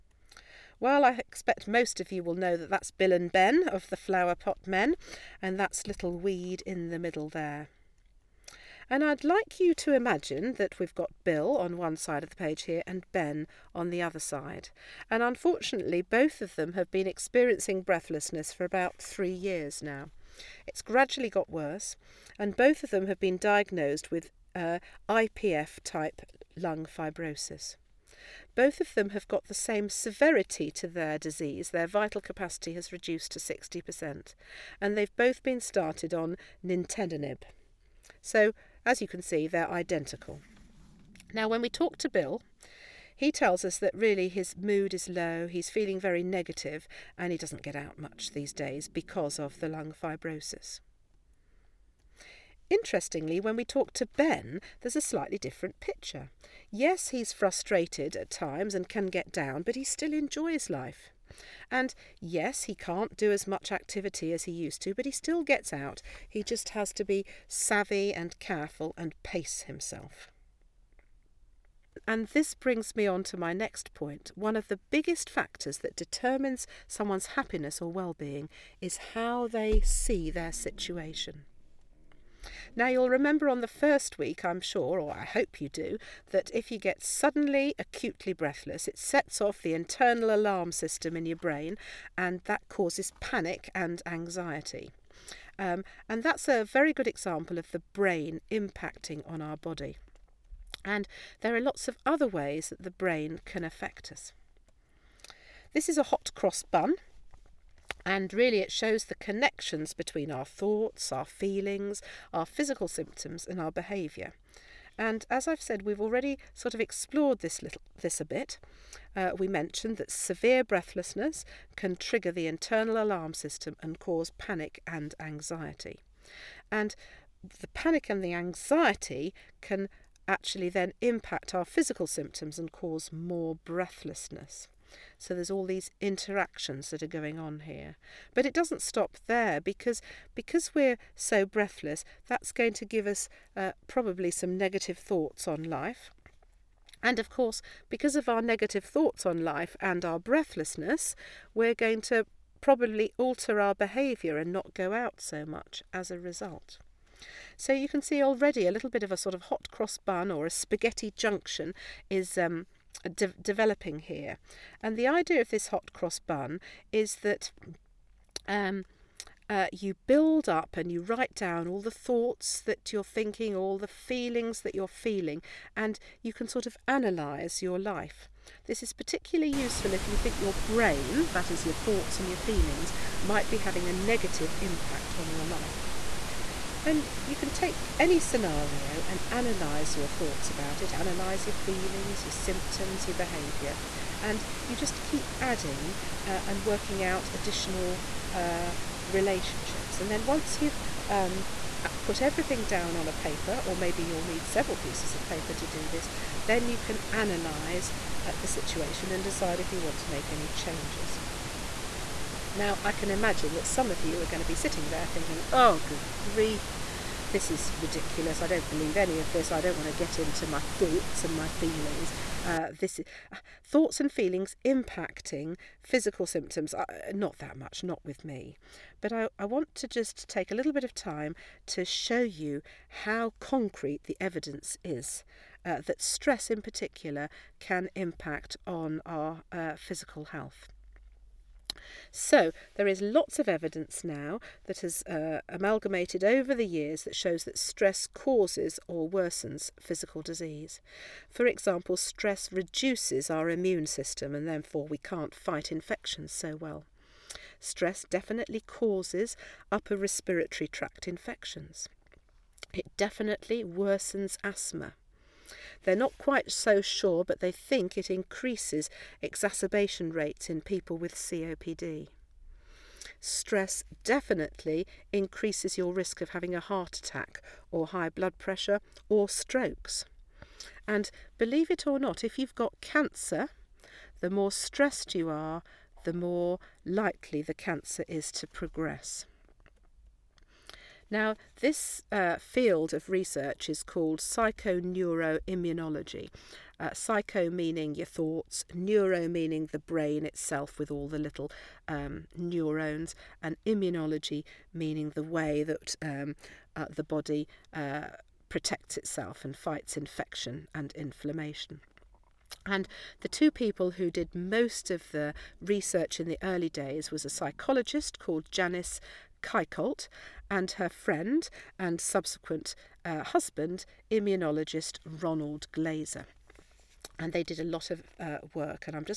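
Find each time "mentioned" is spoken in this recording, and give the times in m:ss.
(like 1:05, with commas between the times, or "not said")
1:59.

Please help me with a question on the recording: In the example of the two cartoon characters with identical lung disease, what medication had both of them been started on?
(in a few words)
nintedanib.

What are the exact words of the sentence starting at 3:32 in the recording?
Now, I can imagine that some of you are going to be sitting there thinking, oh, good grief, this is ridiculous.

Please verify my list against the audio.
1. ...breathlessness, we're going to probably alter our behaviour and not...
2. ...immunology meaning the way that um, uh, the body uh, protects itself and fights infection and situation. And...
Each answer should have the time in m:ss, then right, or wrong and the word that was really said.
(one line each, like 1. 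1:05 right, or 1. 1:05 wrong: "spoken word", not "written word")
1. 2:30 right
2. 5:03 wrong: "inflammation", not "situation".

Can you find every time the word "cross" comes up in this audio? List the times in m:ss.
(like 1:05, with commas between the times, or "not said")
1:46, 2:39, 2:45.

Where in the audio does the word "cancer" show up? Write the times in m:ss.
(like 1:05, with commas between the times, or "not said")
4:42, 4:47.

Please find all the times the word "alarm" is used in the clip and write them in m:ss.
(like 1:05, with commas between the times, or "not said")
1:30, 2:03.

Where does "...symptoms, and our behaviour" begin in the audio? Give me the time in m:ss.
1:52.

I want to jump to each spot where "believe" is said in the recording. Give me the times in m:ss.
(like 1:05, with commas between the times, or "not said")
3:38, 4:41.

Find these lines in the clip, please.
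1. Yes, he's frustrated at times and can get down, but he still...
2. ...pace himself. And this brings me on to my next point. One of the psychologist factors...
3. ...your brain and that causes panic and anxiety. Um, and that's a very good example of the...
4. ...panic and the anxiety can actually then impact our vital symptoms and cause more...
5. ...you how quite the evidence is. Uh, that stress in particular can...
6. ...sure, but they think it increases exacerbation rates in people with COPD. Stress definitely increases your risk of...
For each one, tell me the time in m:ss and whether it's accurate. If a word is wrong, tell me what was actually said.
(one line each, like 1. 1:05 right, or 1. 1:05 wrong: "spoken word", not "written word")
1. 0:56 right
2. 1:09 wrong: "biggest", not "psychologist"
3. 1:31 right
4. 2:07 wrong: "physical", not "vital"
5. 3:52 wrong: "concrete", not "quite"
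6. 4:26 right.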